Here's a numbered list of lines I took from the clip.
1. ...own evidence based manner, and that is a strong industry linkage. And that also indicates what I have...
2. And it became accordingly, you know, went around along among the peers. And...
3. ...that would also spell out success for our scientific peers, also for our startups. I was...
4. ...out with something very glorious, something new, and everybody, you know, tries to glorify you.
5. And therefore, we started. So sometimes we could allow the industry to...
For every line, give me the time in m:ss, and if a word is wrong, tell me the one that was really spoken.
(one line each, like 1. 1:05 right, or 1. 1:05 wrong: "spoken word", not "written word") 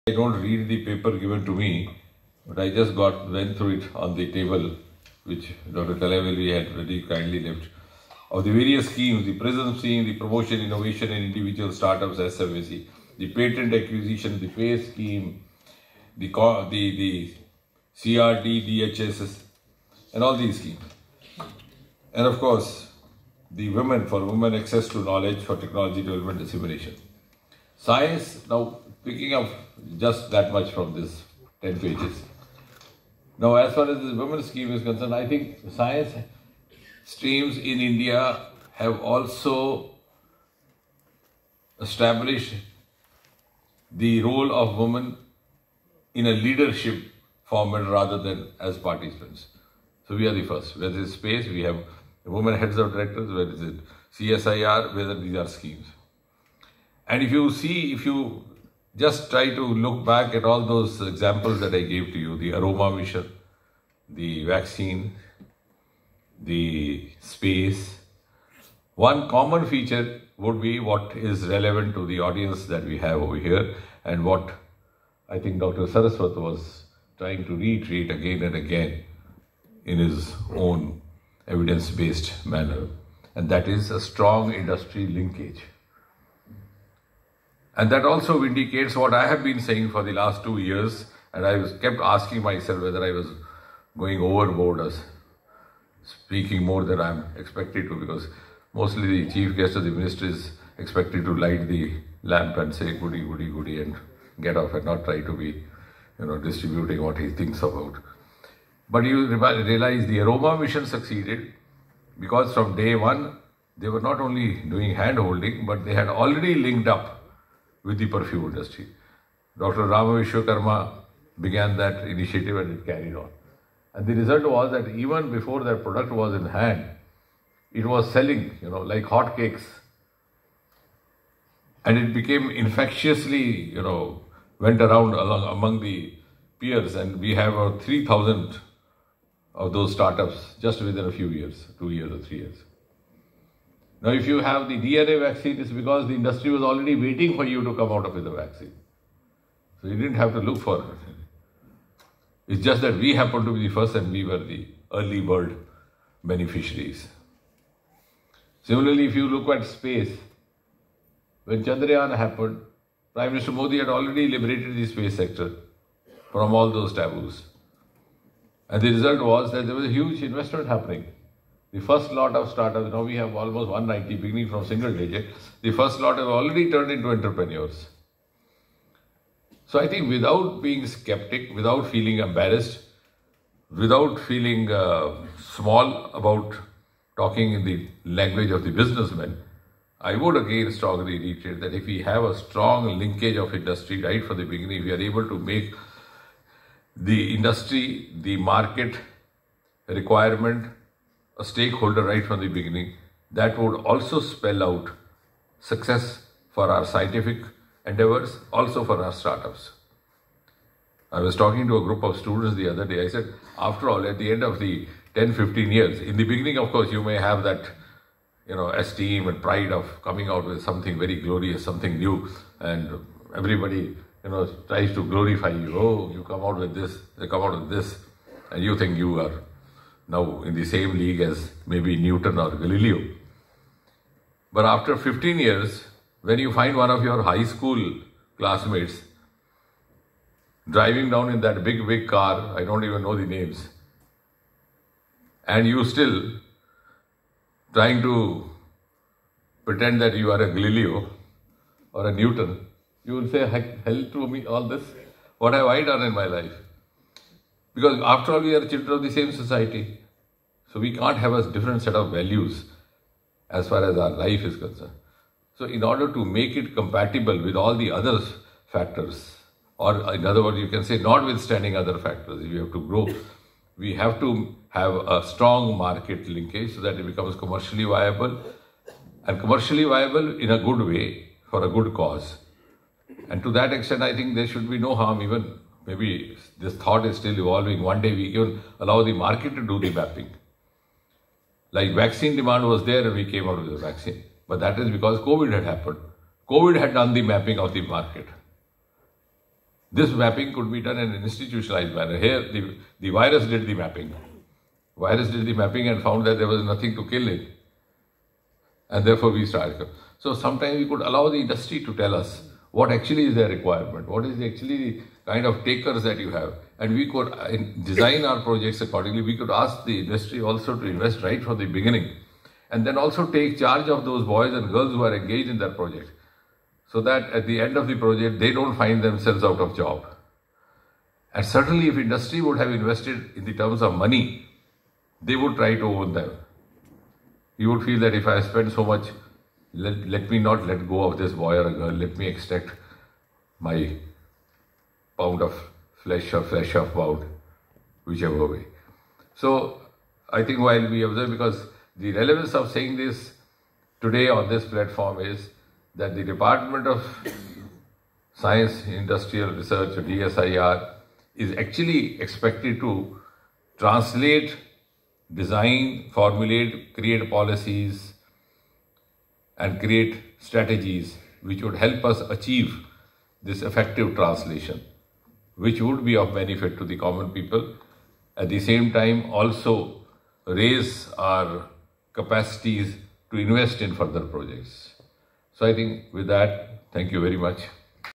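1. 1:20 right
2. 2:11 wrong: "infectiously", not "accordingly"
3. 3:23 wrong: "endeavors", not "peers"
4. 3:40 right
5. 5:08 right.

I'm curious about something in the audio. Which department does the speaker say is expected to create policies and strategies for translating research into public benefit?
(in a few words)
DSIR.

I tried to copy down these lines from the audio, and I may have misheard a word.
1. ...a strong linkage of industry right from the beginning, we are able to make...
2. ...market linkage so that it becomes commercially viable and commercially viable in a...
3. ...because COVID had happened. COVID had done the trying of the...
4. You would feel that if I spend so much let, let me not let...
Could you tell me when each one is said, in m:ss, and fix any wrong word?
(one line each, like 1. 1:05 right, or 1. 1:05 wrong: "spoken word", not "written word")
1. 3:12 right
2. 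4:35 right
3. 4:54 wrong: "mapping", not "trying"
4. 5:37 right.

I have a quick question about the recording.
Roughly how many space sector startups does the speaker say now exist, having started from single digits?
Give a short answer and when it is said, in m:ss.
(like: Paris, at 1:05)
190, at 2:53.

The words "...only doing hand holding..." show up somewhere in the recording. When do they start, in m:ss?
1:54.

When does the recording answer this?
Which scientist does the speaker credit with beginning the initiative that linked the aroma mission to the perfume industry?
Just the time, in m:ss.
1:59.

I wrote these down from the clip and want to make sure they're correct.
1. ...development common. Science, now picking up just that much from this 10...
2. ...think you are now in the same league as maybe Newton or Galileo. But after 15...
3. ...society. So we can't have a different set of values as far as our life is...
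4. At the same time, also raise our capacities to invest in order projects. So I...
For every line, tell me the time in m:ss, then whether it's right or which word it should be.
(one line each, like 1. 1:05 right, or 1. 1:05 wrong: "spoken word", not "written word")
1. 0:26 wrong: "dissemination", not "common"
2. 3:48 right
3. 4:19 right
4. 6:18 wrong: "further", not "order".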